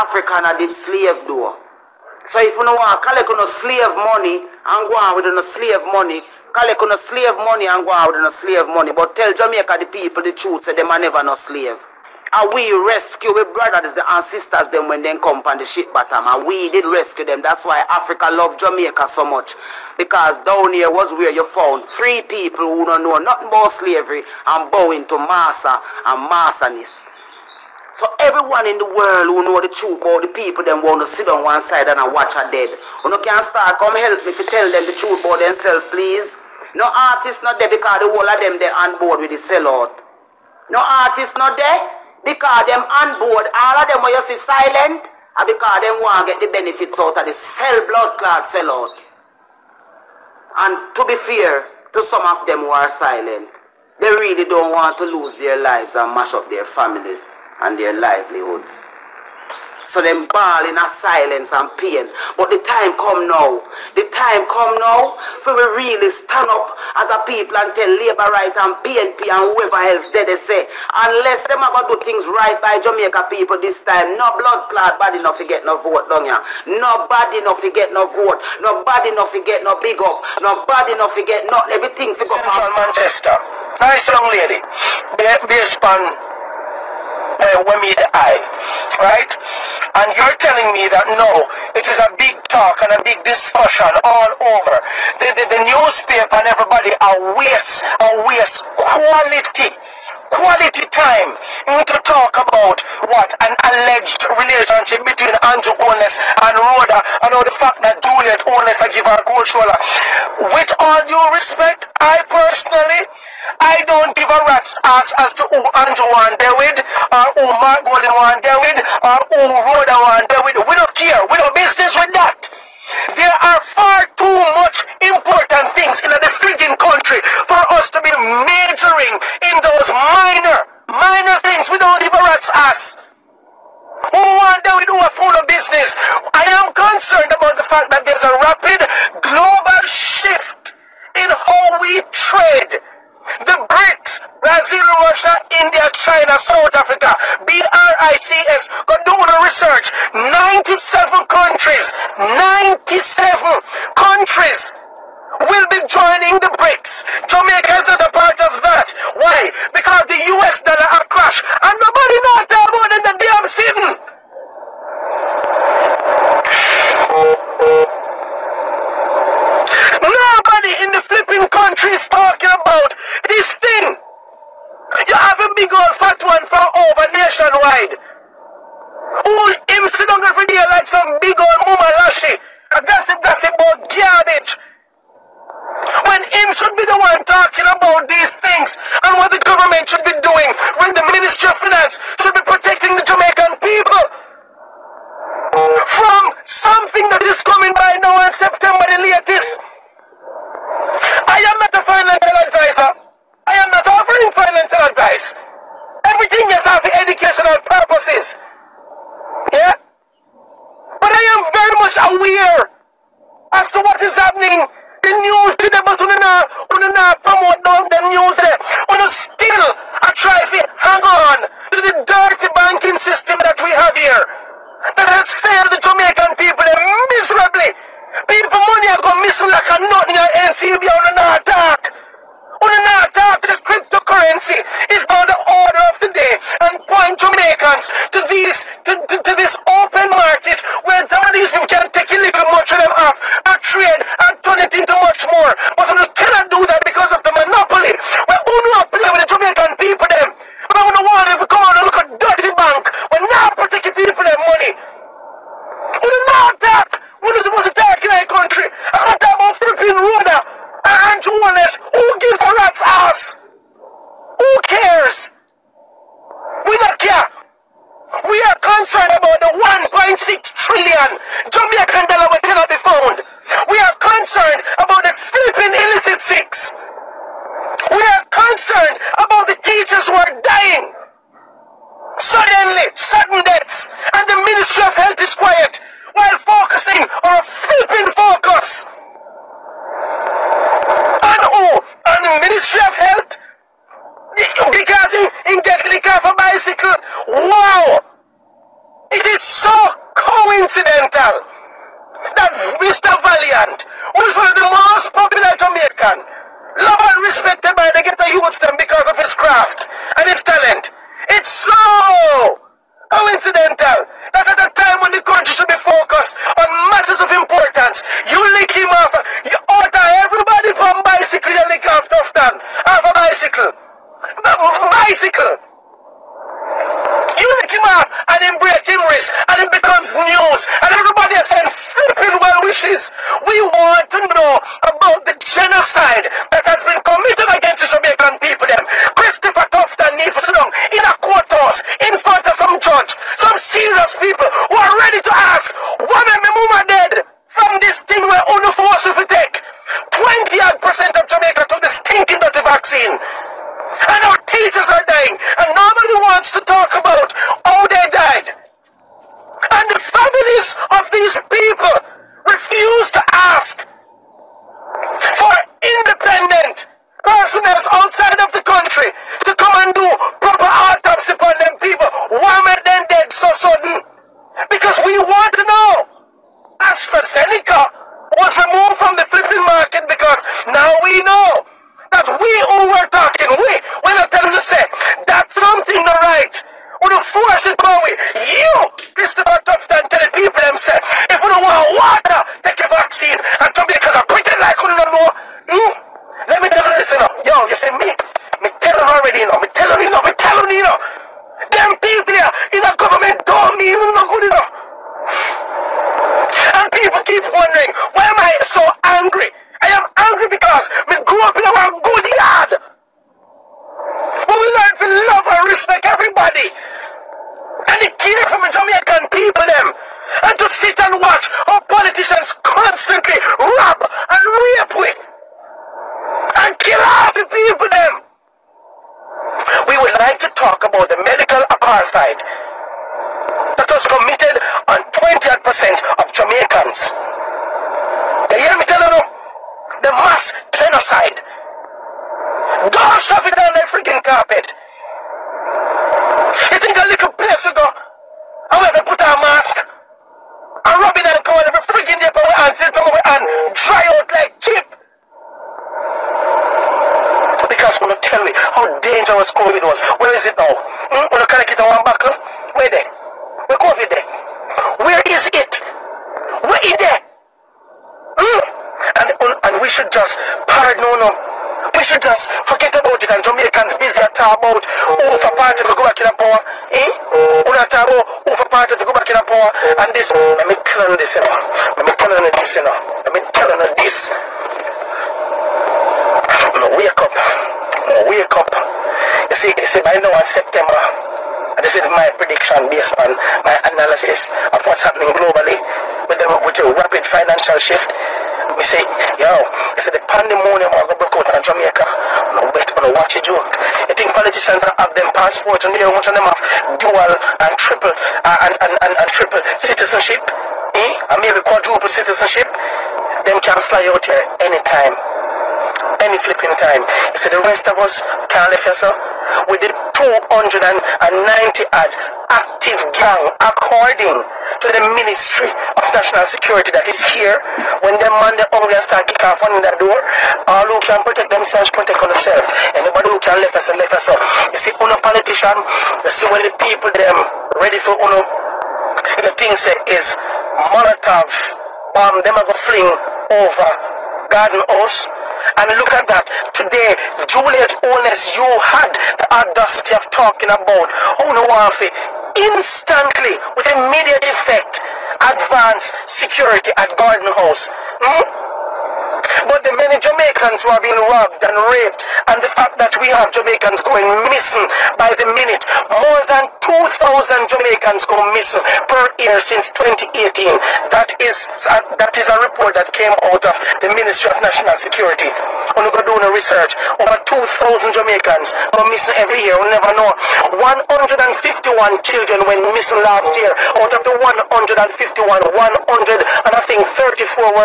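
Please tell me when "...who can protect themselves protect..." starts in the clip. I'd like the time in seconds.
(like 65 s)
530 s.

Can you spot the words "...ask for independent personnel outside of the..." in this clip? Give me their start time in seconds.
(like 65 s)
363 s.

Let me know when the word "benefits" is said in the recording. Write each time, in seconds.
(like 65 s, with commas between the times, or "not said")
46 s.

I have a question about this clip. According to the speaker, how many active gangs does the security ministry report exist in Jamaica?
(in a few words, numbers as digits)
290.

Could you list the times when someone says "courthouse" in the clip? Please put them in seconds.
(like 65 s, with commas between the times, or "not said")
341 s.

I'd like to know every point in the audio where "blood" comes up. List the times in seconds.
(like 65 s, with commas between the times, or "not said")
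47 s, 74 s.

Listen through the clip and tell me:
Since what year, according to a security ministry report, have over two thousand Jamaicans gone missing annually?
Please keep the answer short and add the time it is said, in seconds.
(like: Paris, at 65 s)
2018, at 569 s.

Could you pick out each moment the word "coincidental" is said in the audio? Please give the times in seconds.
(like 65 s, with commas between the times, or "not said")
300 s, 313 s.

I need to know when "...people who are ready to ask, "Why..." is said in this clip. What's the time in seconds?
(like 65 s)
344 s.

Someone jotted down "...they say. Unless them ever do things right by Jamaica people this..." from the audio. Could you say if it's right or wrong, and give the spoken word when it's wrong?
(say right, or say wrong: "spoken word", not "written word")
right.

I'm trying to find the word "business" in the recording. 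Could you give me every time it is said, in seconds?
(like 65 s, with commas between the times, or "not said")
121 s, 135 s.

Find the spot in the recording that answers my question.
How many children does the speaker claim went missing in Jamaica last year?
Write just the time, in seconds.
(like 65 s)
580 s.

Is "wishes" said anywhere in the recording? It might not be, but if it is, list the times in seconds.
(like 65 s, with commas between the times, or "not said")
332 s.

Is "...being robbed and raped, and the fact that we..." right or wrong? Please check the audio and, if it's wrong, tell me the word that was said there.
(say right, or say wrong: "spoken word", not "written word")
right.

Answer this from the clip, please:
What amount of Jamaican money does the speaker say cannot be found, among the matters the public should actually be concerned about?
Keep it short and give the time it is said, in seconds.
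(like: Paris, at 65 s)
1.6 trillion Jamaican dollars, at 269 s.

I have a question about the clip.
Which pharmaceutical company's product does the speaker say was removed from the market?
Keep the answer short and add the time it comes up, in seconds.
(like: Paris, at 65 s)
AstraZeneca, at 376 s.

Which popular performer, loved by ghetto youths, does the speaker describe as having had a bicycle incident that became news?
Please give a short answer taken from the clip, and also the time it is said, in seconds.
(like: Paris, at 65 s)
Valiant, at 302 s.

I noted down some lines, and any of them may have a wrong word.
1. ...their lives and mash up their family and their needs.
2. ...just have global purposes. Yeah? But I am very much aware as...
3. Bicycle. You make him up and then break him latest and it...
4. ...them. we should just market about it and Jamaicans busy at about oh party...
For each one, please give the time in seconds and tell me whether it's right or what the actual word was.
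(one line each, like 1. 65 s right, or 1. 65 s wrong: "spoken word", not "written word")
1. 55 s wrong: "livelihoods", not "needs"
2. 206 s wrong: "educational", not "global"
3. 324 s wrong: "wrist", not "latest"
4. 471 s wrong: "forget", not "market".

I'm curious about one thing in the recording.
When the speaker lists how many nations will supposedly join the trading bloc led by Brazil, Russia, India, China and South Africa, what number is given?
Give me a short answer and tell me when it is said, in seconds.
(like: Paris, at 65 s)
97, at 152 s.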